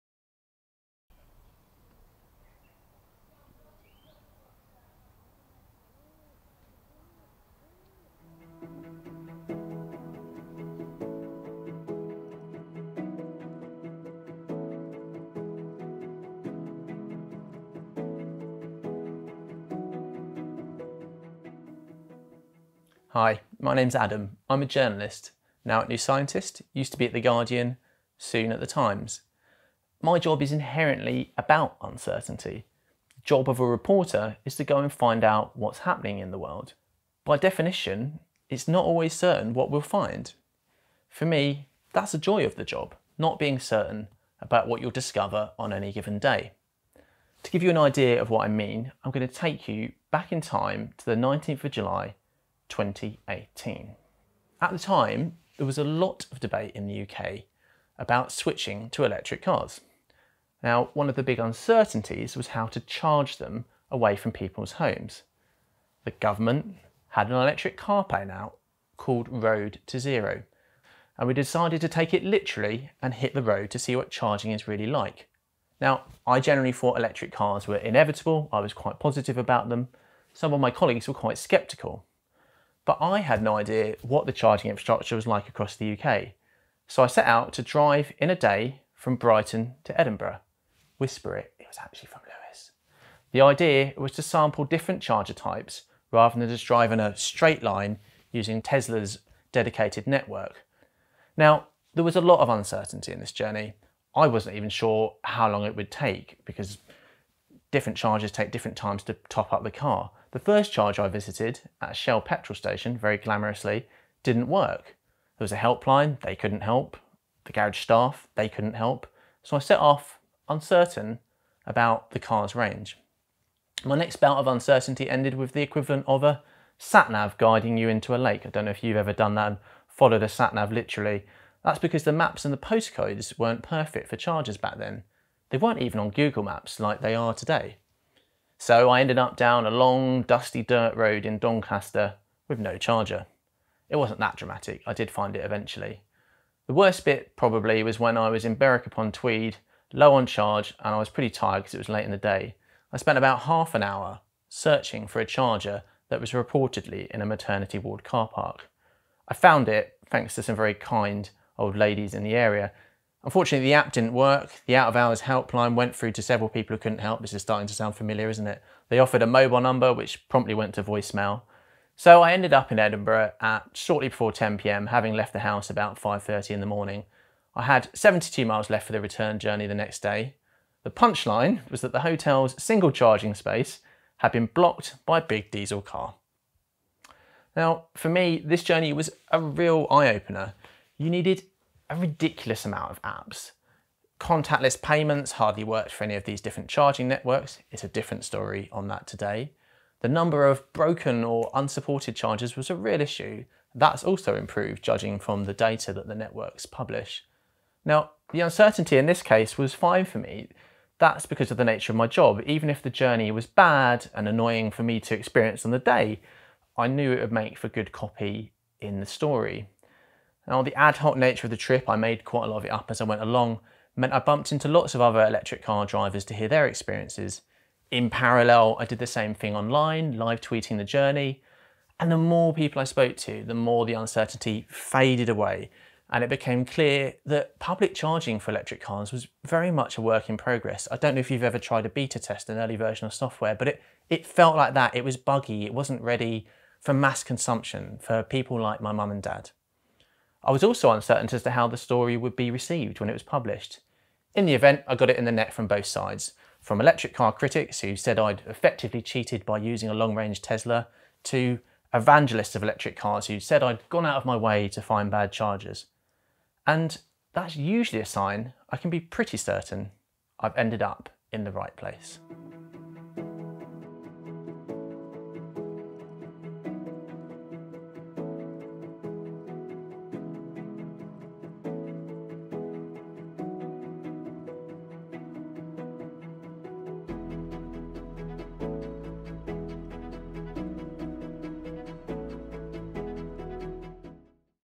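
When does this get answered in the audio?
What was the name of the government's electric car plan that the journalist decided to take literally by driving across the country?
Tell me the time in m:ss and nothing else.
1:09.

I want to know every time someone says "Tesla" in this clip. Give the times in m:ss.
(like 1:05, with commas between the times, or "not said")
1:38, 4:20.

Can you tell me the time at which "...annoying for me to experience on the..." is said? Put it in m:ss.
3:34.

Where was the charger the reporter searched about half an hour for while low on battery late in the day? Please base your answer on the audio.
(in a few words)
Maternity ward car park.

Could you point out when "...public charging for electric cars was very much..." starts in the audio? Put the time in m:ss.
3:57.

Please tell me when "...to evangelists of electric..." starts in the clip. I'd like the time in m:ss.
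4:21.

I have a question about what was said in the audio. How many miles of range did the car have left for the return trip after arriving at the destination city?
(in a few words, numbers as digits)
72.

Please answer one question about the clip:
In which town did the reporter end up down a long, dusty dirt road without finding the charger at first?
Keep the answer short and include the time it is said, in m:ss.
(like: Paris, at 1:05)
Doncaster, at 2:21.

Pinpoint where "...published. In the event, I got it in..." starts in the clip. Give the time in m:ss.
4:13.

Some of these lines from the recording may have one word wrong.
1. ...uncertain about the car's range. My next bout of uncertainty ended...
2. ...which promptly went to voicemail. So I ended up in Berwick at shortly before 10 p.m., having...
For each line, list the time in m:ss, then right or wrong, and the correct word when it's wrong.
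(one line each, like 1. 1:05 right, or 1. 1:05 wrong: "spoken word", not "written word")
1. 2:00 right
2. 2:49 wrong: "Edinburgh", not "Berwick".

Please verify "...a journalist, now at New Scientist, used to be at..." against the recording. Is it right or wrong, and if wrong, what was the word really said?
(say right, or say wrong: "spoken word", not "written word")
right.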